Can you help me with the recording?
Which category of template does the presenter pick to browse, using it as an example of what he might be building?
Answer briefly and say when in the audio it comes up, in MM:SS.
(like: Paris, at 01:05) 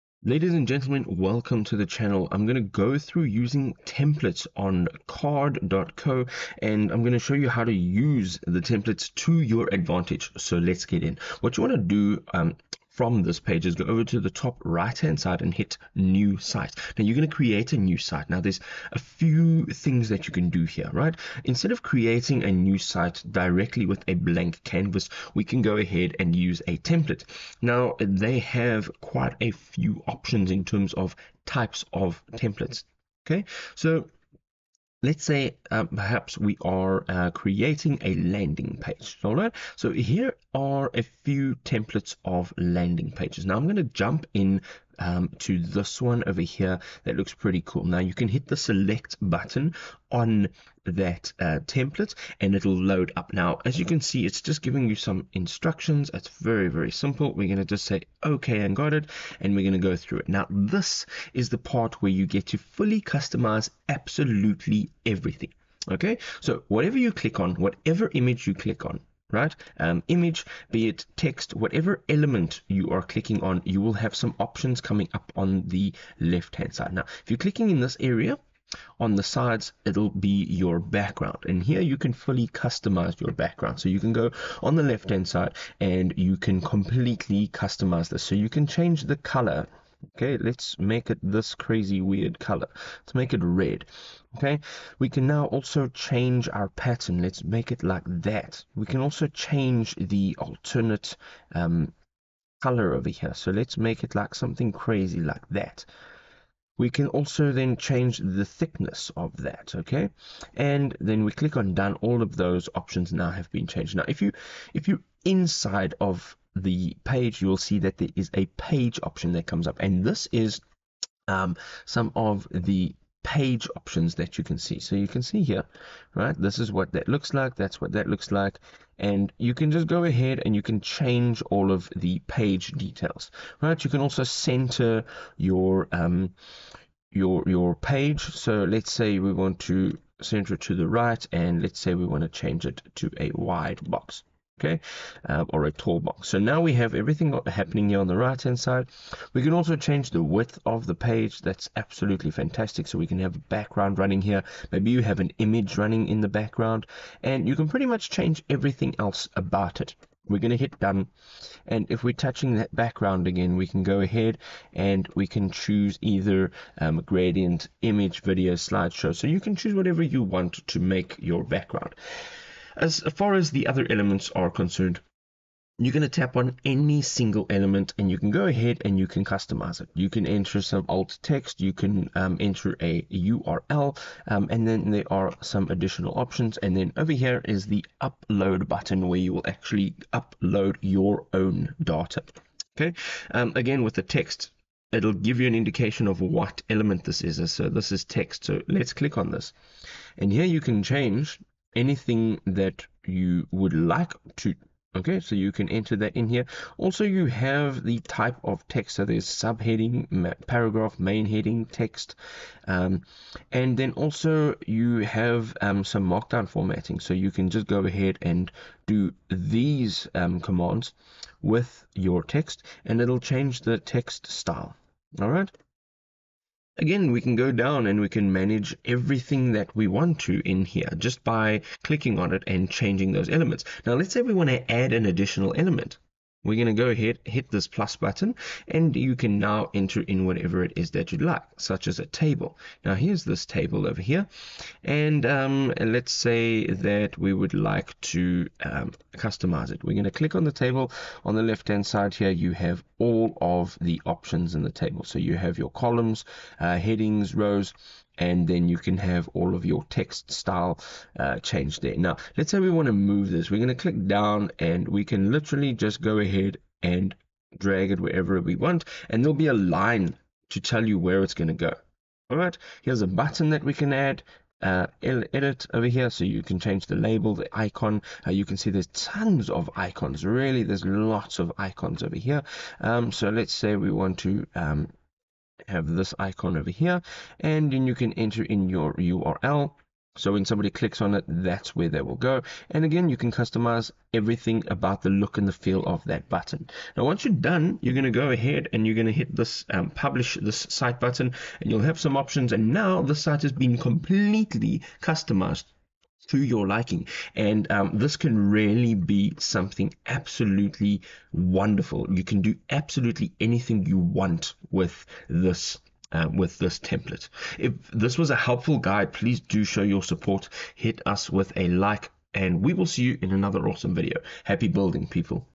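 Landing page, at 00:38.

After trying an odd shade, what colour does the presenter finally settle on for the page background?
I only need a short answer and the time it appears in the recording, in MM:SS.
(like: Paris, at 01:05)
Red, at 01:33.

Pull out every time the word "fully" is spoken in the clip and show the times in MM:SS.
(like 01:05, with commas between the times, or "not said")
01:02, 01:22.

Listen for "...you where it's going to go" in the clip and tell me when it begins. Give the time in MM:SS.
04:30.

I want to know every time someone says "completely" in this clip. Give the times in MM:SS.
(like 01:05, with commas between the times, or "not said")
01:26, 05:03.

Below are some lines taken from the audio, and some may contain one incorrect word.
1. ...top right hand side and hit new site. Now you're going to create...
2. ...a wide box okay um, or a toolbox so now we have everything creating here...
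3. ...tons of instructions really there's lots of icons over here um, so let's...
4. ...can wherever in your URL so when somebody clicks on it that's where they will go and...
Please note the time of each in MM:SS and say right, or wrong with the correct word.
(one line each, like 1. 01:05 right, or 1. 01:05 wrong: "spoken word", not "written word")
1. 00:14 right
2. 02:23 wrong: "happening", not "creating"
3. 04:38 wrong: "icons", not "instructions"
4. 04:47 wrong: "enter", not "wherever".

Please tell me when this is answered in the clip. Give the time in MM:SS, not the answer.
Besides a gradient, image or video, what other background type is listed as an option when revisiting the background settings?
02:48.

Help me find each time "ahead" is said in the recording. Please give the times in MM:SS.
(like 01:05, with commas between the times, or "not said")
00:25, 02:10, 02:44, 02:58, 03:37, 03:56, 04:26, 04:58.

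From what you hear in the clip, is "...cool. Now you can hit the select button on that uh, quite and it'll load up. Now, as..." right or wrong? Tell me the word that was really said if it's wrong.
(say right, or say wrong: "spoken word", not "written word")
wrong: "template", not "quite".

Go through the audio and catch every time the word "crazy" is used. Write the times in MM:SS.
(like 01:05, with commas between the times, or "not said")
01:31, 01:44.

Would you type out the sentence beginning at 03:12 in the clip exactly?
Okay, um, again with the text, it'll give you an indication of what element this is.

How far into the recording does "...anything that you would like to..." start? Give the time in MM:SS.
03:21.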